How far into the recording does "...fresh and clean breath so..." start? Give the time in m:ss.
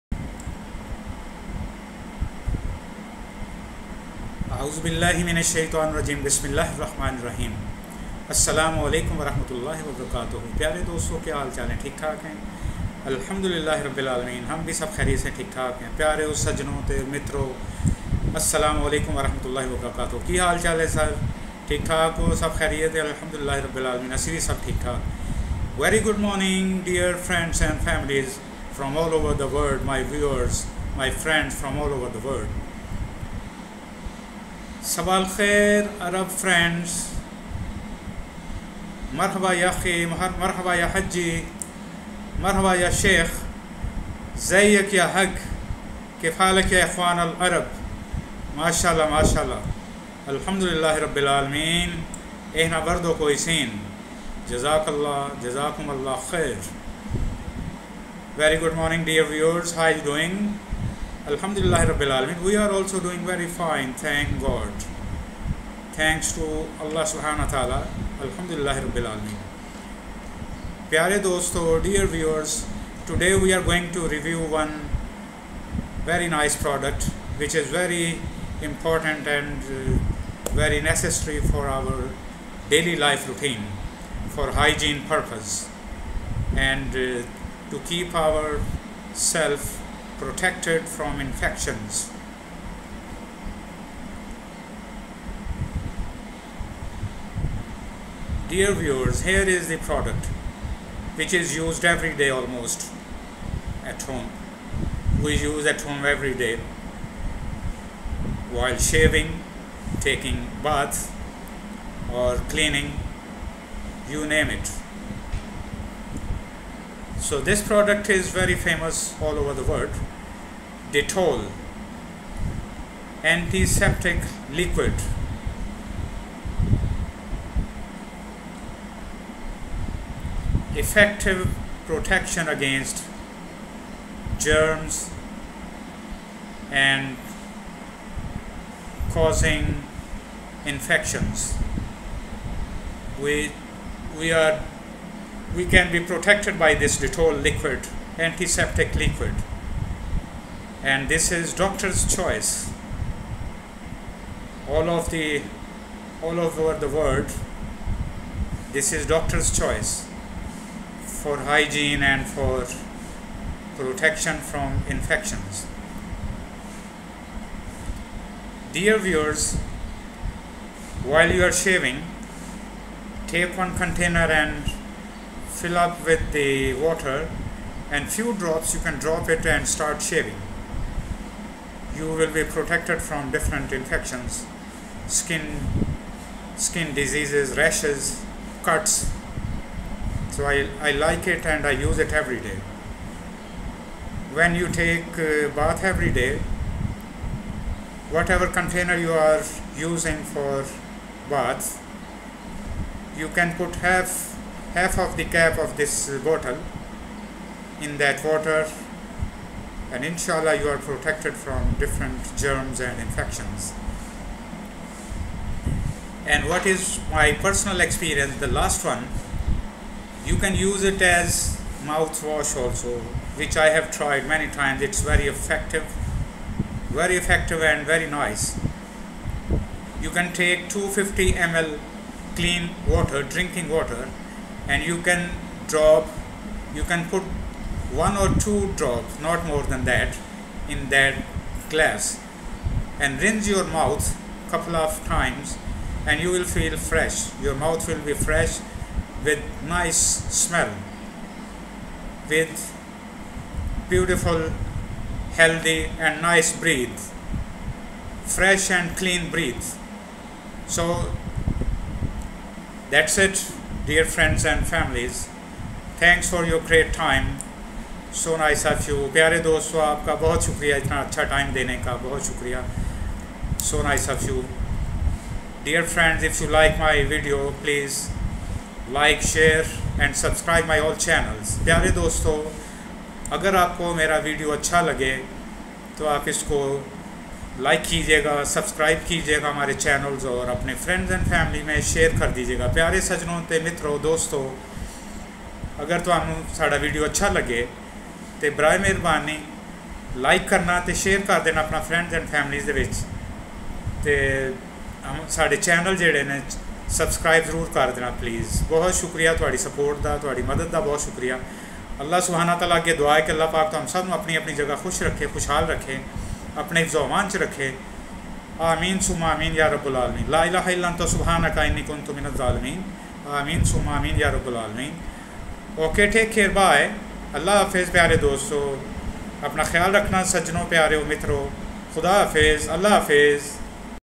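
4:18.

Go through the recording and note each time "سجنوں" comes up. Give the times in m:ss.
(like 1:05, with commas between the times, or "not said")
0:16, 4:53, 5:30.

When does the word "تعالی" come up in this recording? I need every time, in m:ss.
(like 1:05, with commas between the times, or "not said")
5:12.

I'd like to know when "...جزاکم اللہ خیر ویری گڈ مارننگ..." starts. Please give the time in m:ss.
0:55.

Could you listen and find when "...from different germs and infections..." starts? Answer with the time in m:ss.
3:31.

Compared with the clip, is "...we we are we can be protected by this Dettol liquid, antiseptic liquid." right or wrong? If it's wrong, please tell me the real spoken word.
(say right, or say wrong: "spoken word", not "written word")
right.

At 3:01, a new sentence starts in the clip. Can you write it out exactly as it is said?
You will be protected from different infections, skin, skin diseases, rashes, cuts.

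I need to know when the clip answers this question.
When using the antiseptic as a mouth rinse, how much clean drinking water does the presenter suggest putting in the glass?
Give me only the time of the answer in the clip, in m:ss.
3:50.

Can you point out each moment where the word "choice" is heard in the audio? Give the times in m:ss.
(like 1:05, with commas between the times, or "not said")
2:32, 2:39.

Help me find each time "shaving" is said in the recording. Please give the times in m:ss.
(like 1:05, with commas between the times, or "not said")
1:48, 2:51, 3:00.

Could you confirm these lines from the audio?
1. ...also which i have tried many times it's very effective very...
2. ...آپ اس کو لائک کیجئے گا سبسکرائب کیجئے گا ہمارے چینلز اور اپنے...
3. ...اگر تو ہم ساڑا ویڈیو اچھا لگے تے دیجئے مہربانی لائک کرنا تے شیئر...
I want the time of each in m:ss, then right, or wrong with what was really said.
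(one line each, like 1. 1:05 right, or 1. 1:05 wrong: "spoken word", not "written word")
1. 3:42 right
2. 4:46 right
3. 4:55 wrong: "برائے", not "دیجئے".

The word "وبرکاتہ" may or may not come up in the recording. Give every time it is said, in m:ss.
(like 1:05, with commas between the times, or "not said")
0:09, 0:19.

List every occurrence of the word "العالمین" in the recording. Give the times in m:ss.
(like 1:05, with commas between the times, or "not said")
0:14, 0:23, 0:51, 5:19, 5:24.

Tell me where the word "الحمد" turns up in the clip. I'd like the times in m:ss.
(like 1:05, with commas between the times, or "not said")
0:13, 0:23, 0:50.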